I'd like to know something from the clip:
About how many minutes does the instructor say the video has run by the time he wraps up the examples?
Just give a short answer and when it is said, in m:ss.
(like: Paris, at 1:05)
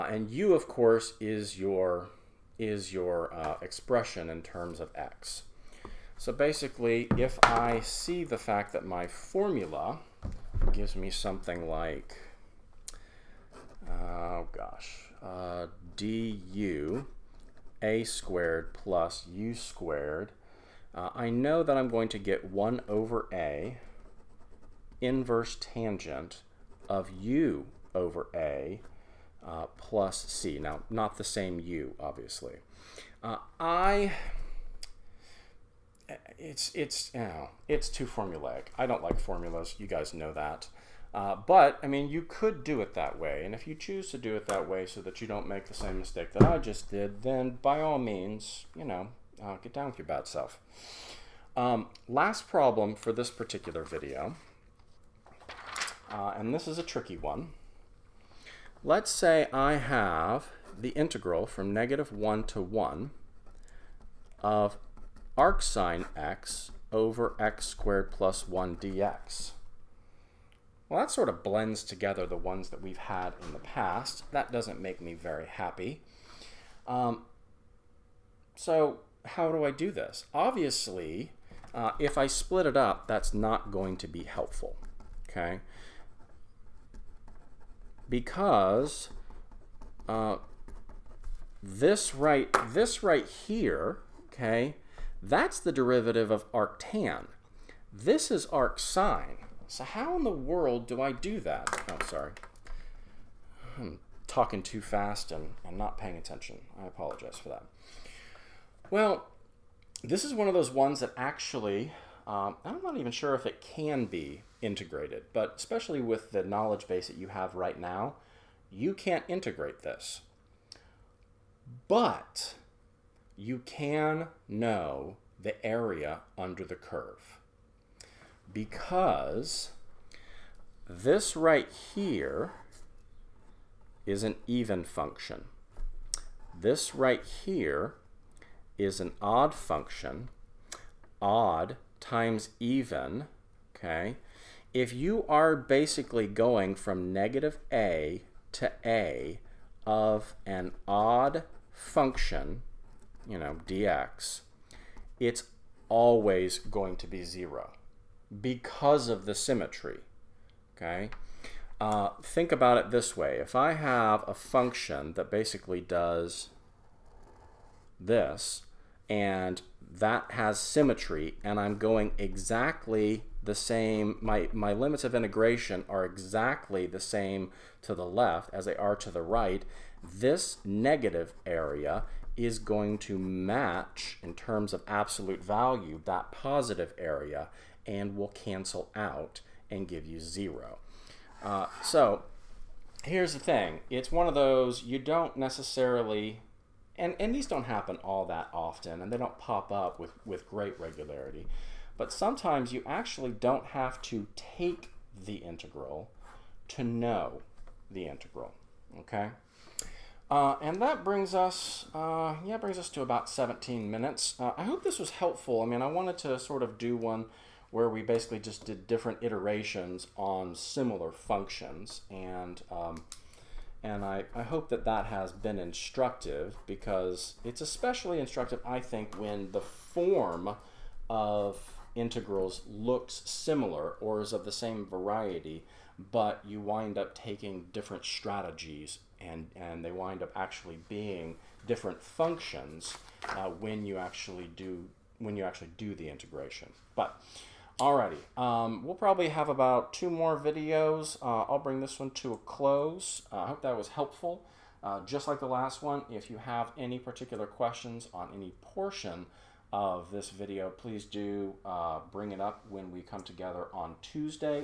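17, at 3:33.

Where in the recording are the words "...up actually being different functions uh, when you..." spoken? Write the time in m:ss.
4:00.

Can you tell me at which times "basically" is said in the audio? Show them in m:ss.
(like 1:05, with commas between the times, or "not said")
0:06, 2:25, 2:45, 3:38.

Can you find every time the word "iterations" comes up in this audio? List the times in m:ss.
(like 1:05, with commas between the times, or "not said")
3:39.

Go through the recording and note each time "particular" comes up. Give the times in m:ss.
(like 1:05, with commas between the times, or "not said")
0:53, 4:16.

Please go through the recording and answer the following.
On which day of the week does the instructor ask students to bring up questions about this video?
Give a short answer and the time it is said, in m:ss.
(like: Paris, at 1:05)
Tuesday, at 4:24.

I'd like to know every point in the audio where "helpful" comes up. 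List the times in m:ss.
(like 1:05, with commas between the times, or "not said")
1:24, 3:35, 4:13.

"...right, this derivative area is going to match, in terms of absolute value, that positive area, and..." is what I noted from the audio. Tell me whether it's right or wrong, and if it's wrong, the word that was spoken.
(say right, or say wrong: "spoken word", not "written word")
wrong: "negative", not "derivative".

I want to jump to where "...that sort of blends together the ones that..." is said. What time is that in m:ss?
1:10.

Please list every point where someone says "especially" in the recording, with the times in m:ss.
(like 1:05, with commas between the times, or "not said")
1:55, 3:47.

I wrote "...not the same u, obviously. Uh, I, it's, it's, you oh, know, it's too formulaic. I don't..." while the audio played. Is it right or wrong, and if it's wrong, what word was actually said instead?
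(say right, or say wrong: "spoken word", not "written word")
right.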